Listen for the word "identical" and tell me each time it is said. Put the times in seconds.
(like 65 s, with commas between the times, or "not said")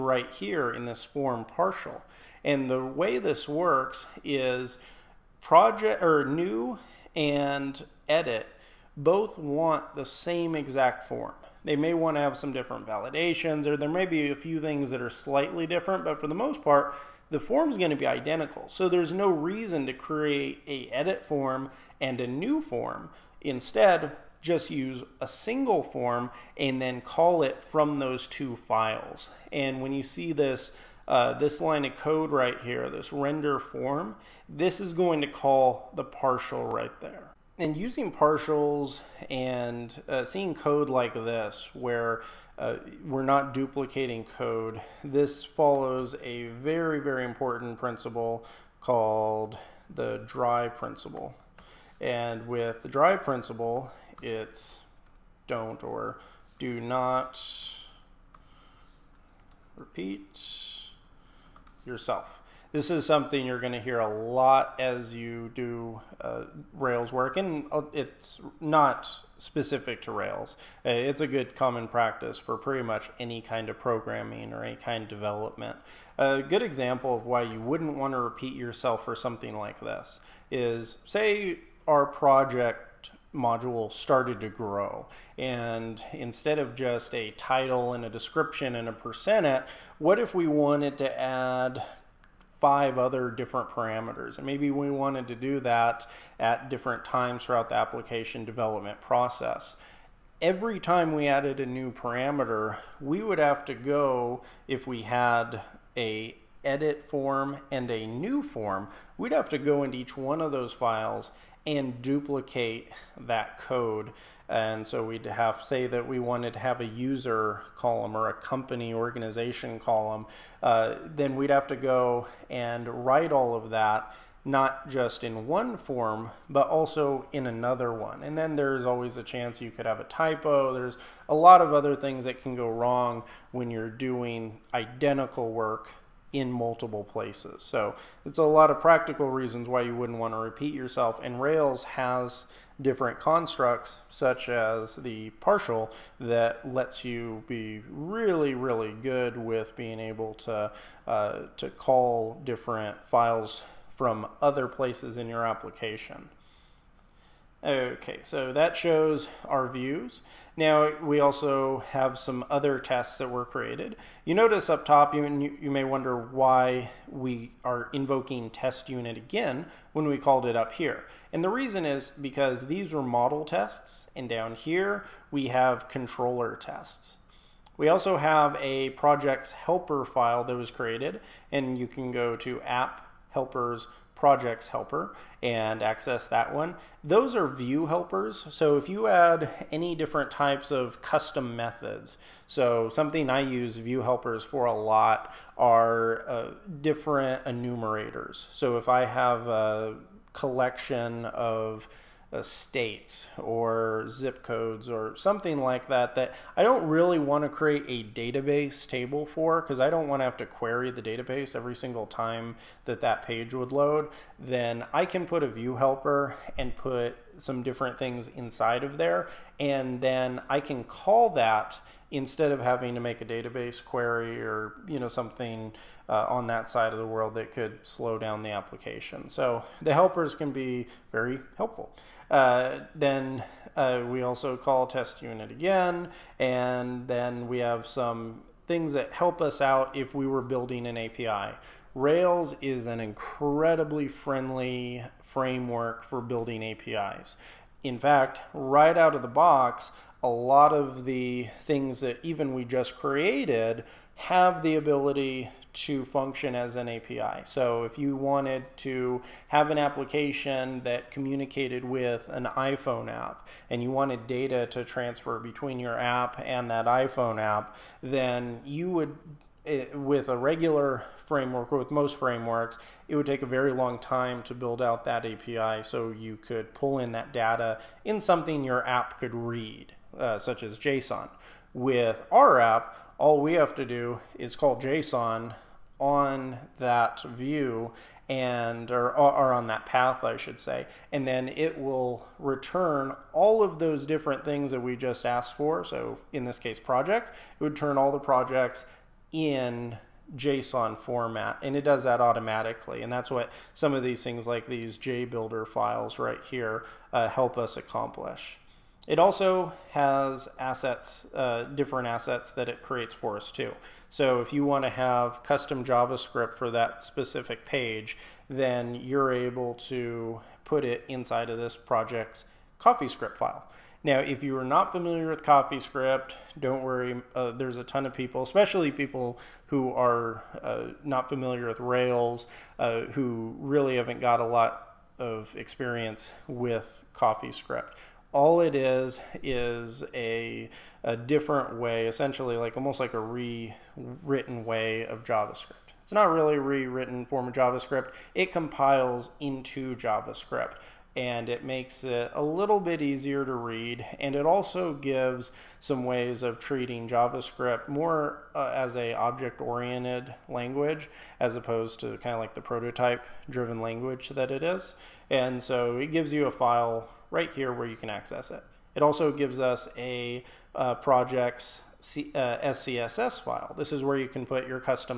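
18 s, 134 s.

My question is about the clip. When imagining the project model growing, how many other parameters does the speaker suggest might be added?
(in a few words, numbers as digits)
5.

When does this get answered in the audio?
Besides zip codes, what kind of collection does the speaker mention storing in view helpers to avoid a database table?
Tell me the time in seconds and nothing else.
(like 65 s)
202 s.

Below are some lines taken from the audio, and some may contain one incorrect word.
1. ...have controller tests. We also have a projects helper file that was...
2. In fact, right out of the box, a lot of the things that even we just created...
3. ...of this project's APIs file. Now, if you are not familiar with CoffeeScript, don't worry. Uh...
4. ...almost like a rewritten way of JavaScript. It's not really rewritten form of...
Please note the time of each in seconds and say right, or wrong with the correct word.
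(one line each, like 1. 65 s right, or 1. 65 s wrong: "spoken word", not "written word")
1. 175 s right
2. 247 s right
3. 321 s wrong: "CoffeeScript", not "APIs"
4. 342 s right.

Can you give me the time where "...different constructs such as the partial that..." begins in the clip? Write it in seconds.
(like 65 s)
142 s.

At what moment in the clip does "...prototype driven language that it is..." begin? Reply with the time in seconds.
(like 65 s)
362 s.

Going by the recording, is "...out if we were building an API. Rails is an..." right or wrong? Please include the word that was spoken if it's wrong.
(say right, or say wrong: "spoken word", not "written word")
right.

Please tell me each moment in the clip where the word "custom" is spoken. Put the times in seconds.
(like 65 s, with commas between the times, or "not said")
191 s, 315 s.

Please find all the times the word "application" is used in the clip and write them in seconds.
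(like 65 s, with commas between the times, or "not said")
97 s, 155 s, 228 s, 259 s.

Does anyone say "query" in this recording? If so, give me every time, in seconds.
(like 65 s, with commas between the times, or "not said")
210 s, 223 s.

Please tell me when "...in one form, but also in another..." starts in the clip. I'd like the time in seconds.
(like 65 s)
125 s.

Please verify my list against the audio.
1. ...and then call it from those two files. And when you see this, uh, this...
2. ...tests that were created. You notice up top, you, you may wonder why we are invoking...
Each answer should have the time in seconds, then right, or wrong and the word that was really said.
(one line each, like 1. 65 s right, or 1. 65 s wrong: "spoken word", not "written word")
1. 26 s right
2. 162 s right.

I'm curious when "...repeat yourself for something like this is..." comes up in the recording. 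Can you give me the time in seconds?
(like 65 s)
78 s.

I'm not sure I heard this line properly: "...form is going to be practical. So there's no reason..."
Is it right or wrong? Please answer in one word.
wrong.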